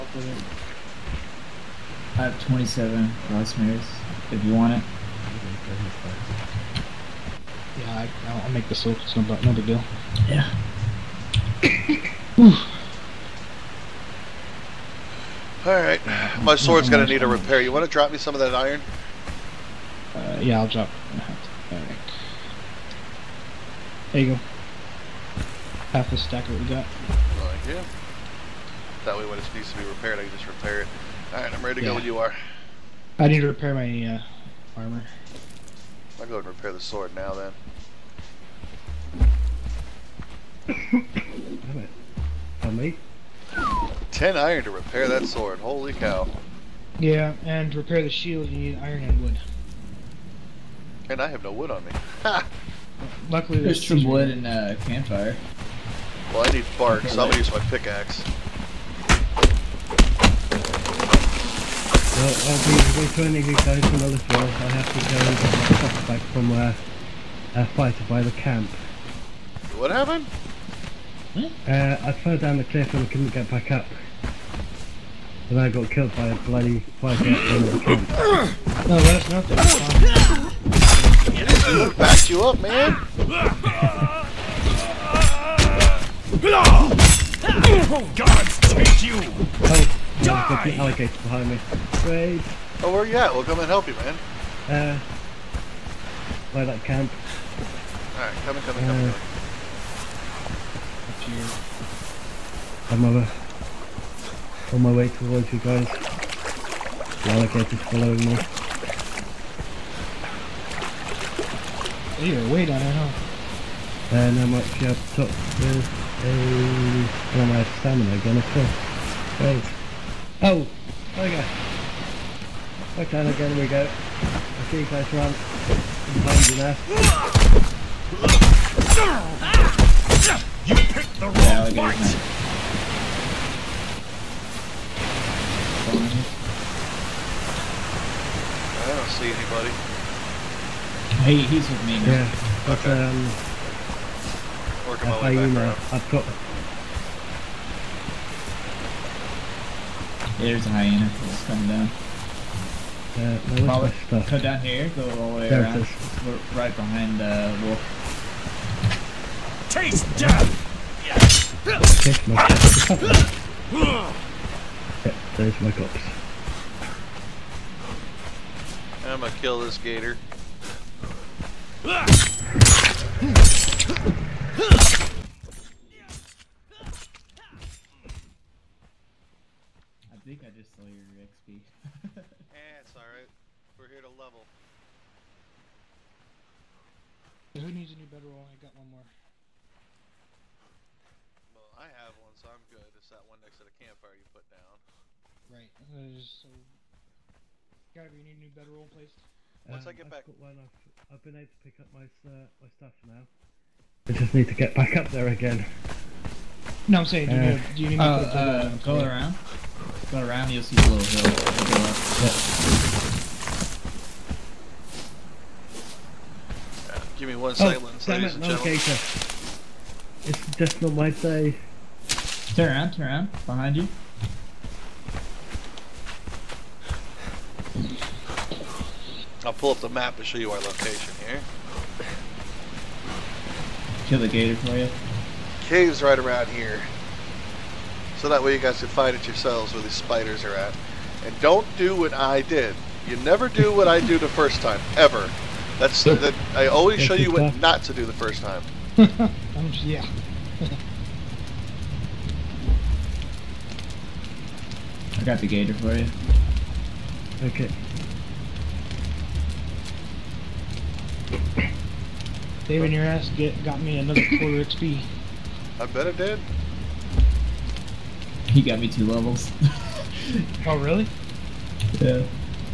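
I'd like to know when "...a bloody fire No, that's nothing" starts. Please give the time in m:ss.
1:16.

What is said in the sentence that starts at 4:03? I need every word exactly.
You never do what I do the first time, ever.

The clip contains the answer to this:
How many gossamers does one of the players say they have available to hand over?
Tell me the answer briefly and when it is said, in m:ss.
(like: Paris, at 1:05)
27, at 0:02.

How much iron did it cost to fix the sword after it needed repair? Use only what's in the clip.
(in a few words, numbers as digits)
10.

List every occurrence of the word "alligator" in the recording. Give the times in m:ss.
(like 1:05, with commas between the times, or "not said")
1:30, 1:47.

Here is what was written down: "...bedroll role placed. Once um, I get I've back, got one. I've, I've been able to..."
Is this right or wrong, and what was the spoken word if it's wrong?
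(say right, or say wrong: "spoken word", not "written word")
right.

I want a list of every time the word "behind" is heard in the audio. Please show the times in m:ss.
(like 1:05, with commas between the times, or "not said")
1:31, 2:06, 2:36, 3:43.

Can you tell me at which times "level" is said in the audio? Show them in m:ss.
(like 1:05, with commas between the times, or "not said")
3:04, 4:29.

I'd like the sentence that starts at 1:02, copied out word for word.
Well, I'll be to get guys another floor.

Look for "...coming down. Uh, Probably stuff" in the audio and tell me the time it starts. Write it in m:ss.
2:31.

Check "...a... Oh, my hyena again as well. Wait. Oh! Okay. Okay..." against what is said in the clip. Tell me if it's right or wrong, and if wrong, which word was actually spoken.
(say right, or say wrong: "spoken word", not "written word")
wrong: "stamina", not "hyena".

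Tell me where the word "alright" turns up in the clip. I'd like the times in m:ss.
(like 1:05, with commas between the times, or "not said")
0:15, 0:21, 0:31, 1:38, 3:02.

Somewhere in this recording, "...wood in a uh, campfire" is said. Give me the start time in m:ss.
0:54.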